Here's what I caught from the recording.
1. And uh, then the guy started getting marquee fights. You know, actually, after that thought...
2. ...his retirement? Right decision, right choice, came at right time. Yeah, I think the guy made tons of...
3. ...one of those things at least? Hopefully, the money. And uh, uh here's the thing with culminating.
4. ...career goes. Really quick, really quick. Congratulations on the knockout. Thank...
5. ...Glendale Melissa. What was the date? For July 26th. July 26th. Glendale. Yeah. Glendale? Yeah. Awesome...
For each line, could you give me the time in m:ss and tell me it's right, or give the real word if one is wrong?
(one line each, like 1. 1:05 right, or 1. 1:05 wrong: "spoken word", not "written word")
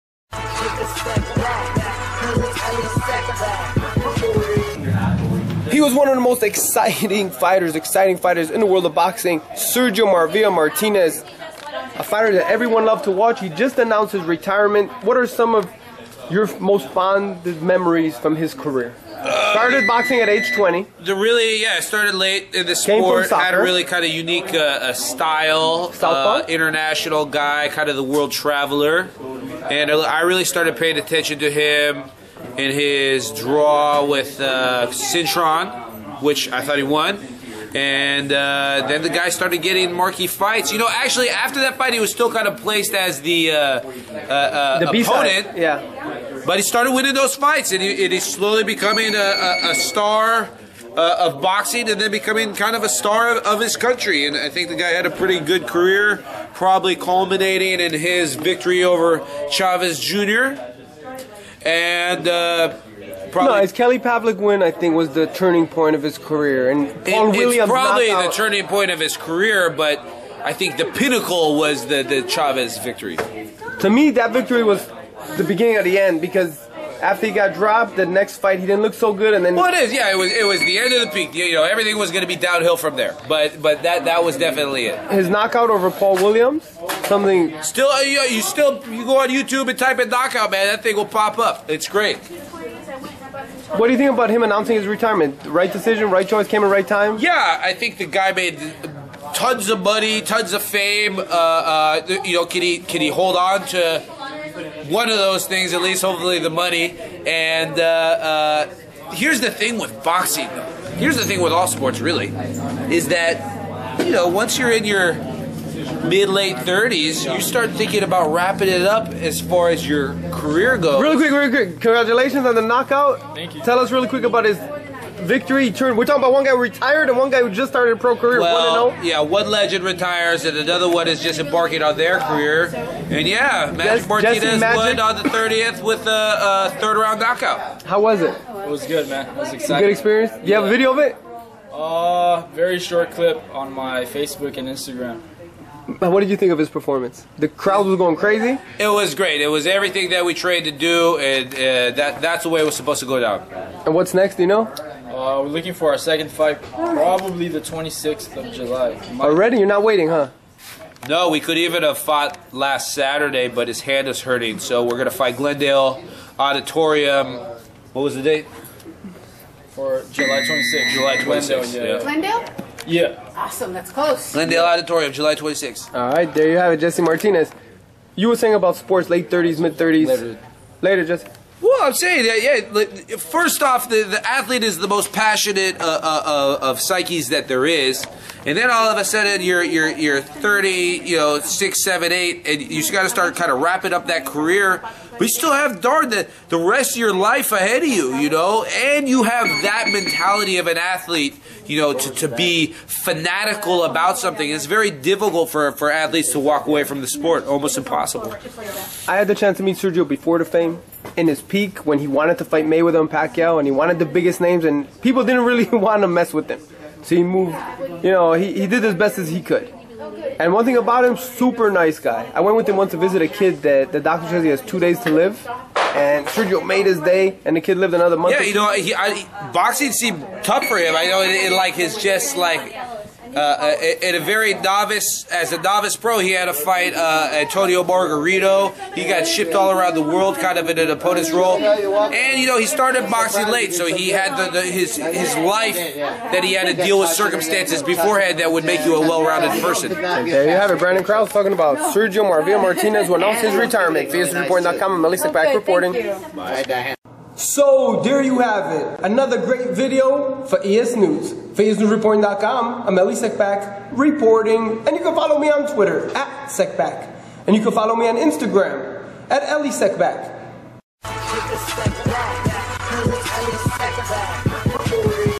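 1. 0:37 wrong: "fight", not "thought"
2. 1:34 right
3. 1:44 wrong: "boxing", not "culminating"
4. 2:00 right
5. 2:45 wrong: "Auditorium", not "Melissa".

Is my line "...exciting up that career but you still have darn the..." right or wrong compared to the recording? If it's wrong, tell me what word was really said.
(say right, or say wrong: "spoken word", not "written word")
wrong: "wrapping", not "exciting".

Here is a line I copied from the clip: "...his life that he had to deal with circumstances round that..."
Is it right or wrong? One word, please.
wrong.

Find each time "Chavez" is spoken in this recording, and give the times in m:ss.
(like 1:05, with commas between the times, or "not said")
0:59, 1:12.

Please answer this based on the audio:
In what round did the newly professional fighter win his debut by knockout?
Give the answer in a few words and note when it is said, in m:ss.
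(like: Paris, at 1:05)
third round, at 2:16.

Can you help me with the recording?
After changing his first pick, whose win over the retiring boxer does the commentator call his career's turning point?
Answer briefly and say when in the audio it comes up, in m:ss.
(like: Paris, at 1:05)
Paul Williams, at 1:07.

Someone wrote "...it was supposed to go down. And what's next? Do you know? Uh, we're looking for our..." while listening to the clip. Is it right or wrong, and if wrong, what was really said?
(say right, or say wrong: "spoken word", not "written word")
right.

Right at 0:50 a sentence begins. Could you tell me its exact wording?
Uh, of boxing and then becoming kind of a star of, of his country.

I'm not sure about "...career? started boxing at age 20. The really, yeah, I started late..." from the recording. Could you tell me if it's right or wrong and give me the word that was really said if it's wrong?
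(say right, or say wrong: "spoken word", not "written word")
right.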